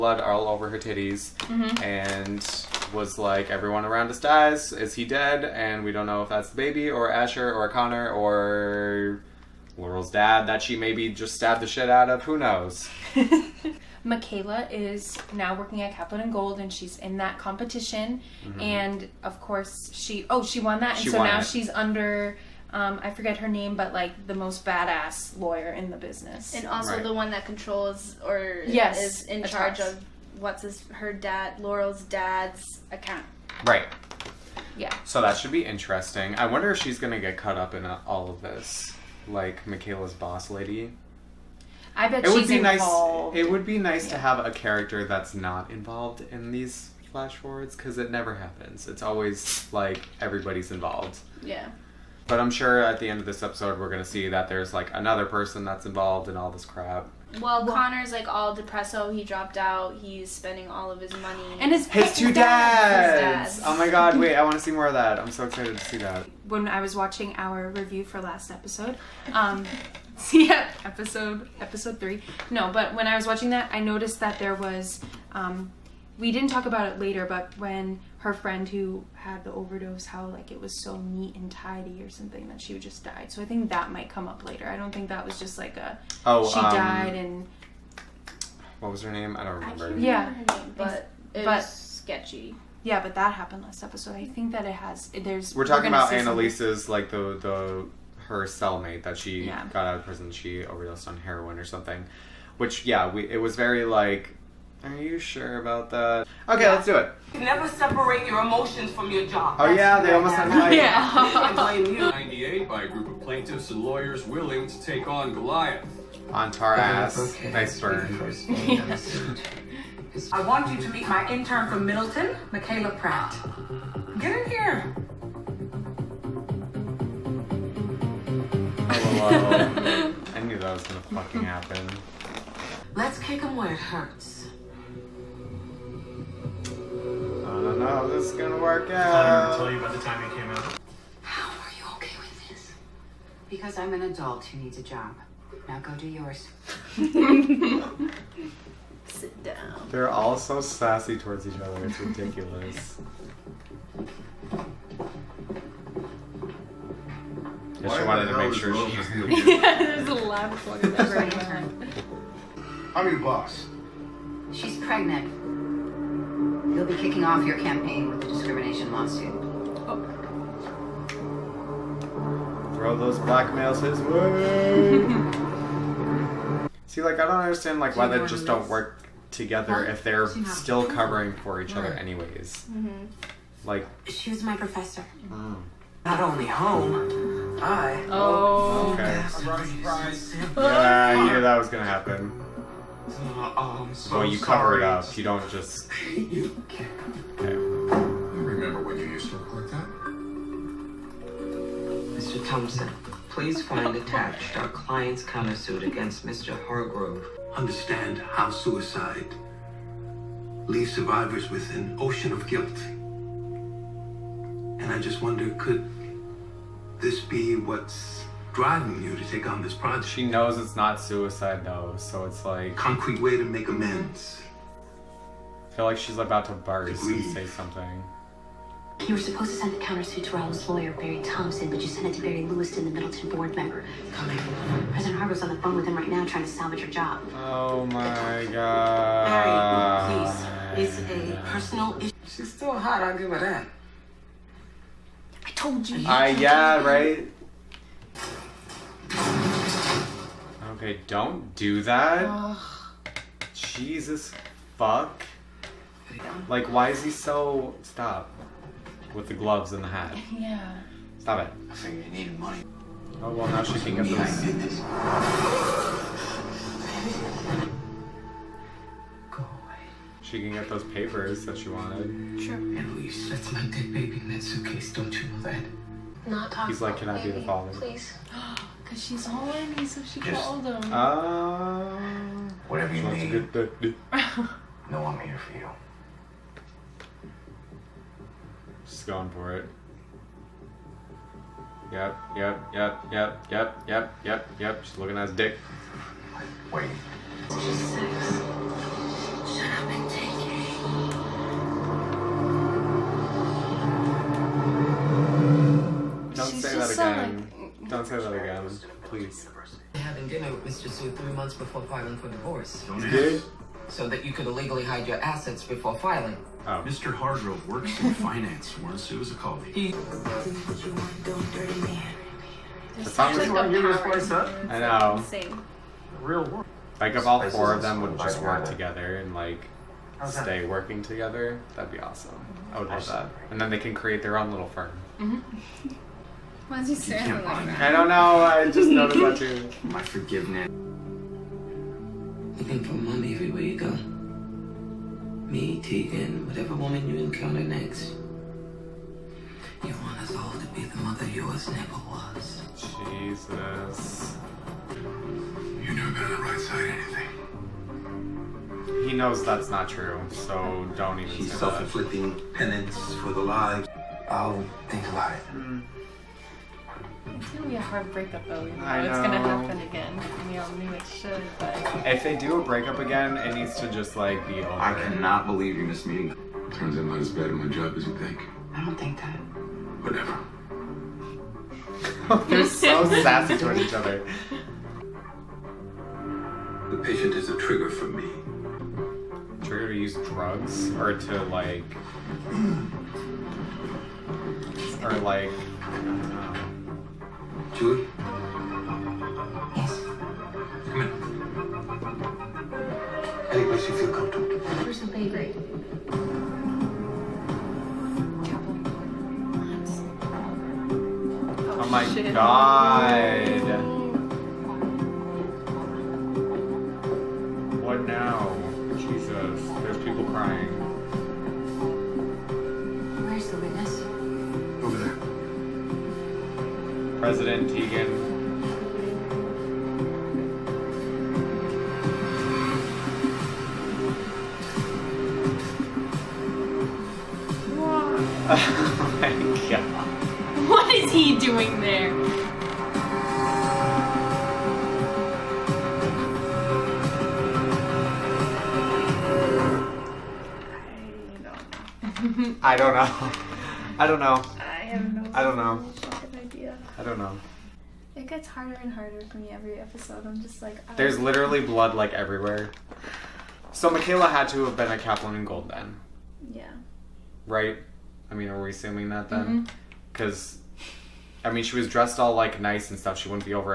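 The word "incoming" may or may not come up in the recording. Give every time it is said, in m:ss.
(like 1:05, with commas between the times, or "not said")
not said.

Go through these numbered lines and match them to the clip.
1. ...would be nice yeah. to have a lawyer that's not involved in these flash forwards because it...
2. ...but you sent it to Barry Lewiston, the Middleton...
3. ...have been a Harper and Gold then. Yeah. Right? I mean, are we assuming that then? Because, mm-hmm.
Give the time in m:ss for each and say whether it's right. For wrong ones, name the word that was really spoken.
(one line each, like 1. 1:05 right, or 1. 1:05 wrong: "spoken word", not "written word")
1. 0:43 wrong: "character", not "lawyer"
2. 3:51 right
3. 7:44 wrong: "Kaplan", not "Harper".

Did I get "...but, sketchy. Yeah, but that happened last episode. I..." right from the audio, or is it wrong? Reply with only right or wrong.
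right.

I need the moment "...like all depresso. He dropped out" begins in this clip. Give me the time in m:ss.
0:58.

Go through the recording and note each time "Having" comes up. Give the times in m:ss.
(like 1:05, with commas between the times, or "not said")
5:09.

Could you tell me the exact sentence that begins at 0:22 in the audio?
Um, I forget her name, but like the most badass lawyer in the business, and also right.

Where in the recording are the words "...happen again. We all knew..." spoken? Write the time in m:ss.
6:09.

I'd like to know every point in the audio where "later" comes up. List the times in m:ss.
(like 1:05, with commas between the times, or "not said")
1:16, 1:24.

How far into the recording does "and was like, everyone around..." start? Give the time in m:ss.
0:01.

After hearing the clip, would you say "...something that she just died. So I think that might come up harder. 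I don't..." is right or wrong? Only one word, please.
wrong.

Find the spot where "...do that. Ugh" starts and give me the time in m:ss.
4:11.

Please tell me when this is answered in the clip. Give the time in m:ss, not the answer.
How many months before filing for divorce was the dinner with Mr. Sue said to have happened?
5:11.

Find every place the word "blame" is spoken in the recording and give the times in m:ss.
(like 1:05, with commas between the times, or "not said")
1:51.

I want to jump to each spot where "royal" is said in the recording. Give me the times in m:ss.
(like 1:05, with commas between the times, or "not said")
not said.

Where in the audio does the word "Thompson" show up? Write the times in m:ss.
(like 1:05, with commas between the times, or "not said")
3:22, 3:51.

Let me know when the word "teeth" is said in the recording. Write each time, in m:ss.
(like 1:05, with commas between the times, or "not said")
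not said.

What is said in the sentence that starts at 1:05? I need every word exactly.
I'm so excited to see that.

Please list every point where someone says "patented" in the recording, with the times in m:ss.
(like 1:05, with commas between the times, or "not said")
not said.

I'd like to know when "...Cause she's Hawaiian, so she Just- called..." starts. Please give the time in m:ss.
4:38.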